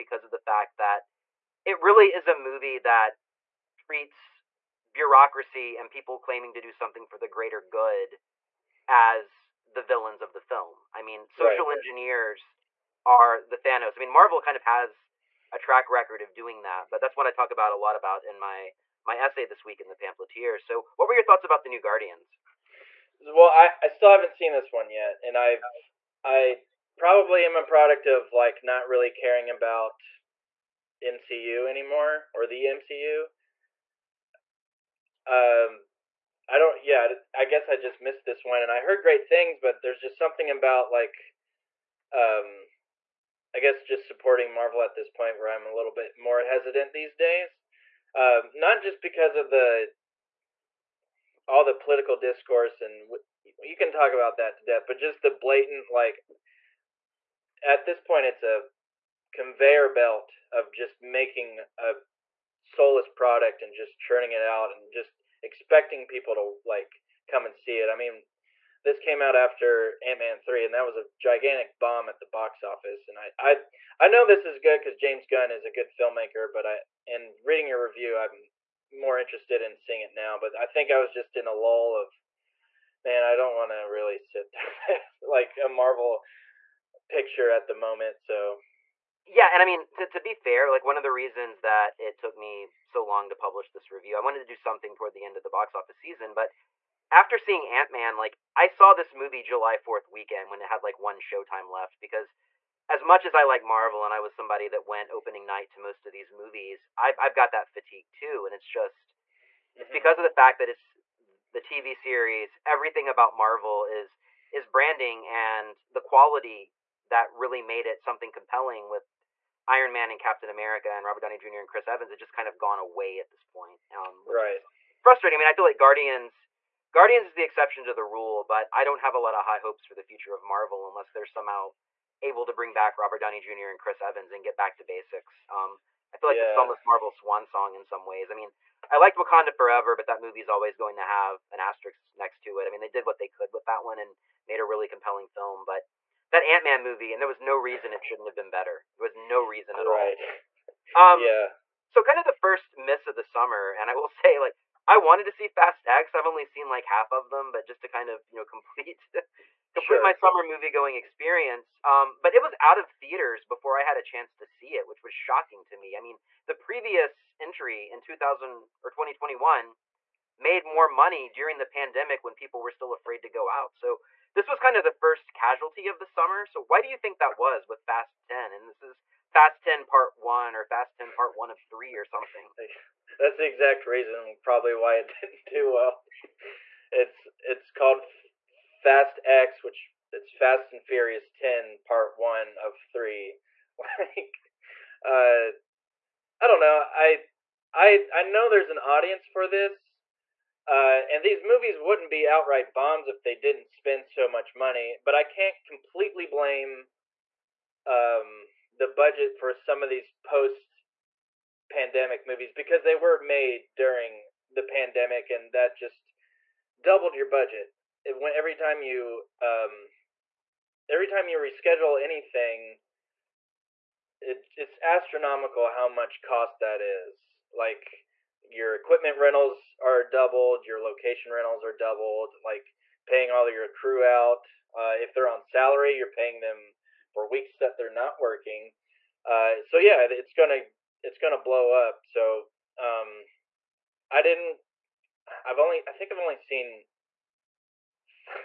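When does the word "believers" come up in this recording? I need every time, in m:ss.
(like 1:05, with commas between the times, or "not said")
not said.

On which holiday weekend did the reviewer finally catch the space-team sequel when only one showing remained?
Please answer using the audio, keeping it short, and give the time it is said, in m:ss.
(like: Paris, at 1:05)
July 4th weekend, at 1:39.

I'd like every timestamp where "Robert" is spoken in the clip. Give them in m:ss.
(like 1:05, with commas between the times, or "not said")
2:01, 2:12.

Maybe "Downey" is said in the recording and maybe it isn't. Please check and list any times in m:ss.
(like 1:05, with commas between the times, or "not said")
2:01, 2:13.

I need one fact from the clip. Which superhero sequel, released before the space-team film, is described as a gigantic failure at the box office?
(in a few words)
Ant Man 3.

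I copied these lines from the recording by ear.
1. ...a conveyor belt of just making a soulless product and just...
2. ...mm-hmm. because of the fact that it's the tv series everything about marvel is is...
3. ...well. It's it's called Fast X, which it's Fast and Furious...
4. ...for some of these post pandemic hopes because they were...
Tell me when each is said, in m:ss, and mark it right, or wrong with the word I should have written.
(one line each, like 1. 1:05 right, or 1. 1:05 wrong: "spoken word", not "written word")
1. 0:58 right
2. 1:49 right
3. 3:05 right
4. 3:29 wrong: "movies", not "hopes".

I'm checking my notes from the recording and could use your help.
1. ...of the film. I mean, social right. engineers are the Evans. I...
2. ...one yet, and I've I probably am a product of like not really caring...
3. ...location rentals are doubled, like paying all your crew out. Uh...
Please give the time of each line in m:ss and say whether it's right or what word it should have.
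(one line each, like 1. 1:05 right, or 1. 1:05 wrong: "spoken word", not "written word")
1. 0:10 wrong: "Thanos", not "Evans"
2. 0:24 right
3. 3:50 right.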